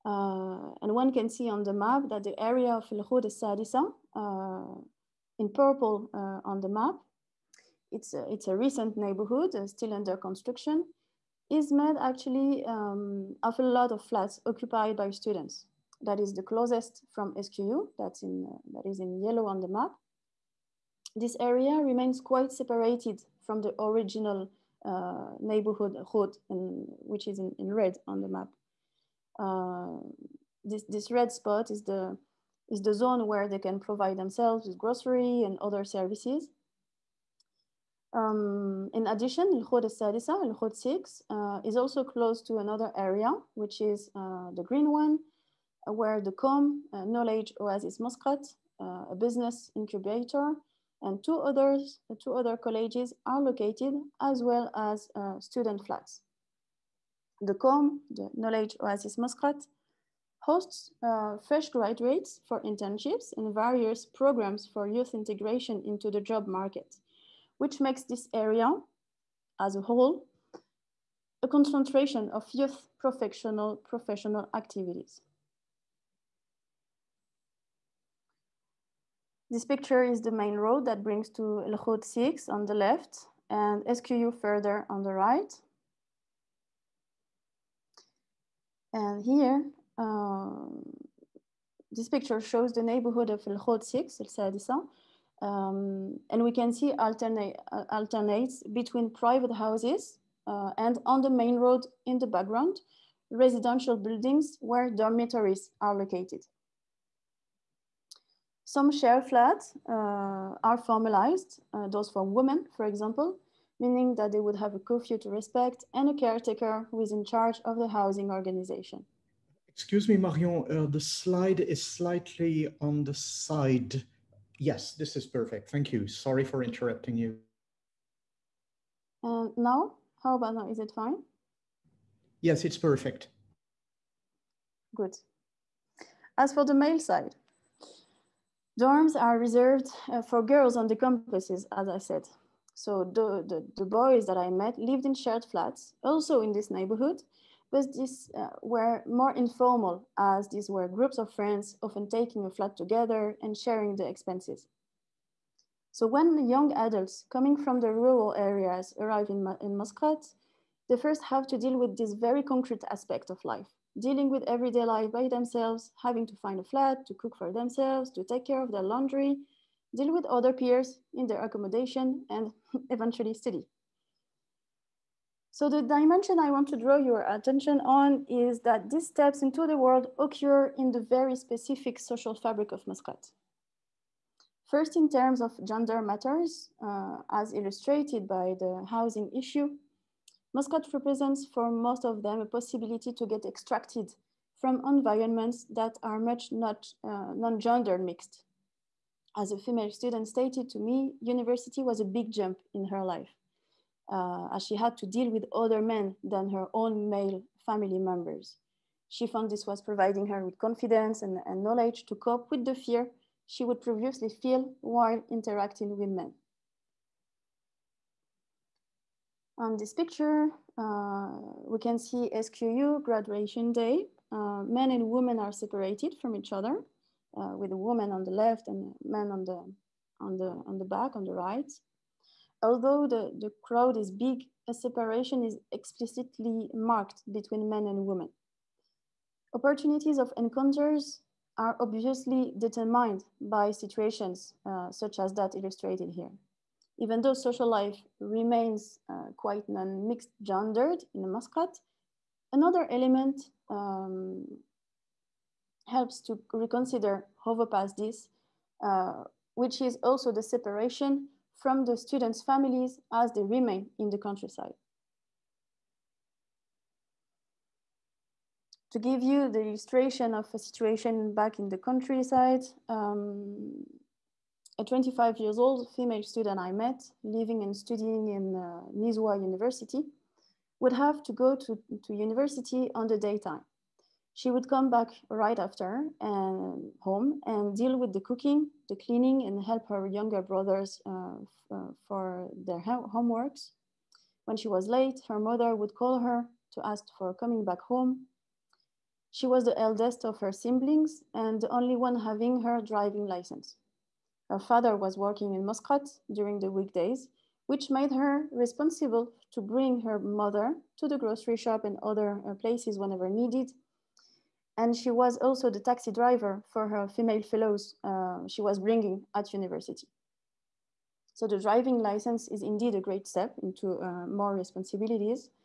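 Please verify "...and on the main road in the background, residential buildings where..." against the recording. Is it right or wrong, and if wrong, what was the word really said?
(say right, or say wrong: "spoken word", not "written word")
right.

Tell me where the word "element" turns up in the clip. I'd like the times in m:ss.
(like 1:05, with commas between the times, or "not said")
4:12.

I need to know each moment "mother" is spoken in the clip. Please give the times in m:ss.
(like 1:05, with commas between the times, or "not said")
4:55, 5:10.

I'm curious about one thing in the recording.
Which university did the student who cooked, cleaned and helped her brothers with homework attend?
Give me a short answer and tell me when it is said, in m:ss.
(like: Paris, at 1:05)
Nizwa University, at 4:38.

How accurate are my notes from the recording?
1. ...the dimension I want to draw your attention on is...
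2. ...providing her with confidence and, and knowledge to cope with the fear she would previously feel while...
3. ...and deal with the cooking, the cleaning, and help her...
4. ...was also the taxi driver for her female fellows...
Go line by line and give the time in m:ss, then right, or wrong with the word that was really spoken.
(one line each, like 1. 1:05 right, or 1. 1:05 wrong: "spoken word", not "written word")
1. 2:55 right
2. 3:29 right
3. 4:47 right
4. 5:15 right.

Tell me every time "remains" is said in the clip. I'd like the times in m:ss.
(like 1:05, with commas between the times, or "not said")
0:21, 4:08, 4:23.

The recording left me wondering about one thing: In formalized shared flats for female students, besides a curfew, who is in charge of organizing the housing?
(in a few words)
A caretaker.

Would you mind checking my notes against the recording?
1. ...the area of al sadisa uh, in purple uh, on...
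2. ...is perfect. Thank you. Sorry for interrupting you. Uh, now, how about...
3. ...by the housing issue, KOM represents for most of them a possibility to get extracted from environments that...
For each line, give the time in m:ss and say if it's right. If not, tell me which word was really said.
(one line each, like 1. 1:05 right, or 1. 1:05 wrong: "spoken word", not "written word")
1. 0:02 right
2. 2:05 right
3. 3:08 wrong: "Muscat", not "KOM".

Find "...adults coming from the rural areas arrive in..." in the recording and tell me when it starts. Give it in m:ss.
2:36.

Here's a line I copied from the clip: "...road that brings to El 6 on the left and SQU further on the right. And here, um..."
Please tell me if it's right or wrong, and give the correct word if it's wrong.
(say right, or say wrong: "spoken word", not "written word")
right.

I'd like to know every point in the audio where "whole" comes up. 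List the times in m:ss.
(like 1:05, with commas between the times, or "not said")
1:09.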